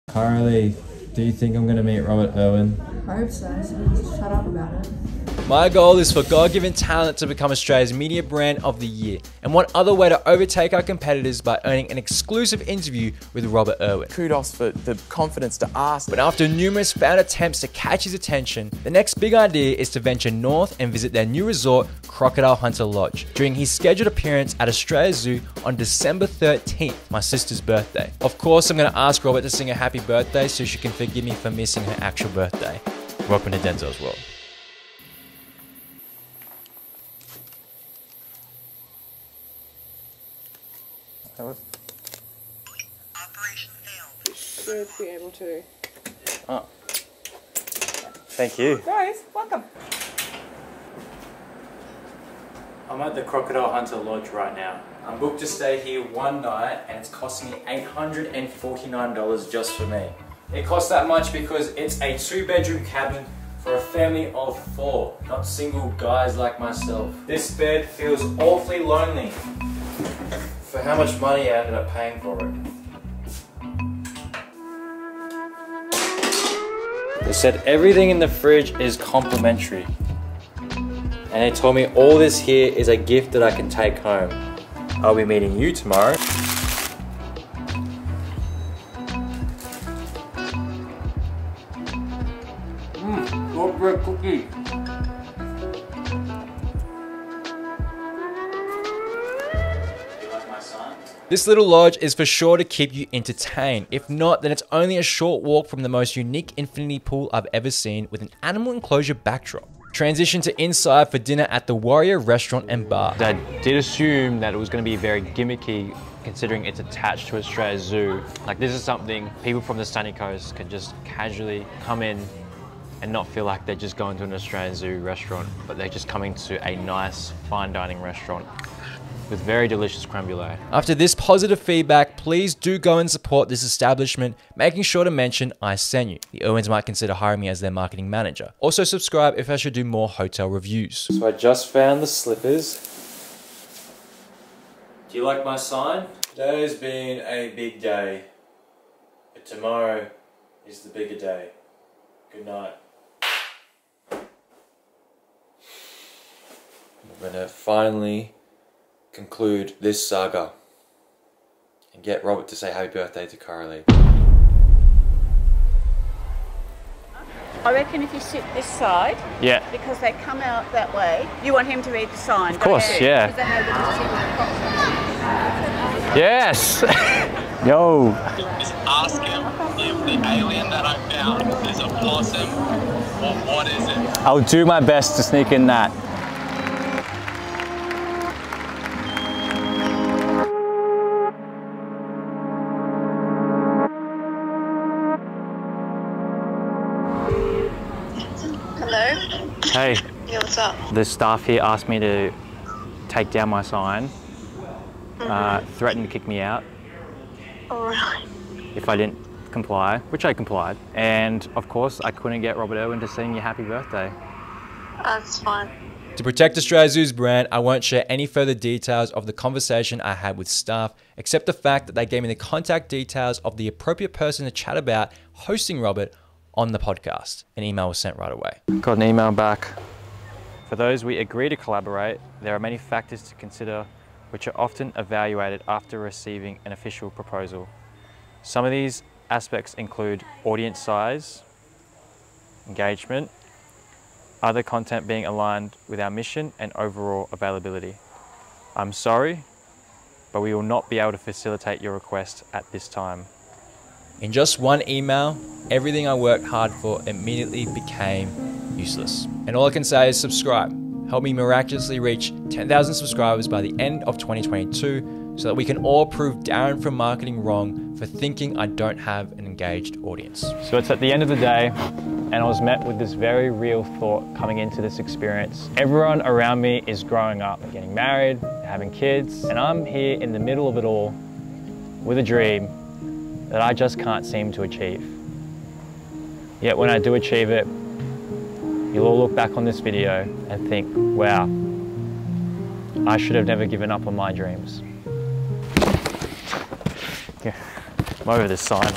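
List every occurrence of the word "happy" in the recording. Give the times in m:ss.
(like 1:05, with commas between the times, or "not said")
0:29, 2:42, 3:33.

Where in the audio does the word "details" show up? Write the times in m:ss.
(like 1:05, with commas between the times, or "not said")
3:38, 3:42.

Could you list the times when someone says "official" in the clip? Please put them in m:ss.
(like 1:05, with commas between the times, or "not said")
3:56.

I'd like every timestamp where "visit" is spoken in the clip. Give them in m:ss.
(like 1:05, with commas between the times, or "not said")
0:20.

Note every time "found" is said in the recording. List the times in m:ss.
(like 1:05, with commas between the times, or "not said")
2:21, 3:01.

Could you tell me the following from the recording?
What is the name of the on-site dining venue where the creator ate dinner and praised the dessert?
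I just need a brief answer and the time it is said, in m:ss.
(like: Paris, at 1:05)
Warrior Restaurant and Bar, at 1:51.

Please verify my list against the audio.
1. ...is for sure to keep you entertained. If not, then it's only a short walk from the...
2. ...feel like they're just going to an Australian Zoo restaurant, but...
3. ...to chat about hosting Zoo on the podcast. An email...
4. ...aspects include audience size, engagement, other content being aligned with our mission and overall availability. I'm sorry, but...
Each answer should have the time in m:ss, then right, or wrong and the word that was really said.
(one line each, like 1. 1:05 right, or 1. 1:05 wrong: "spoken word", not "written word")
1. 1:42 right
2. 2:03 right
3. 3:44 wrong: "Robert", not "Zoo"
4. 3:59 right.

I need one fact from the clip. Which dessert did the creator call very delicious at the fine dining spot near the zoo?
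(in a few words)
Creme brulee.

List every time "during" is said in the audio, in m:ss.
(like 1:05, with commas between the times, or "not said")
0:23.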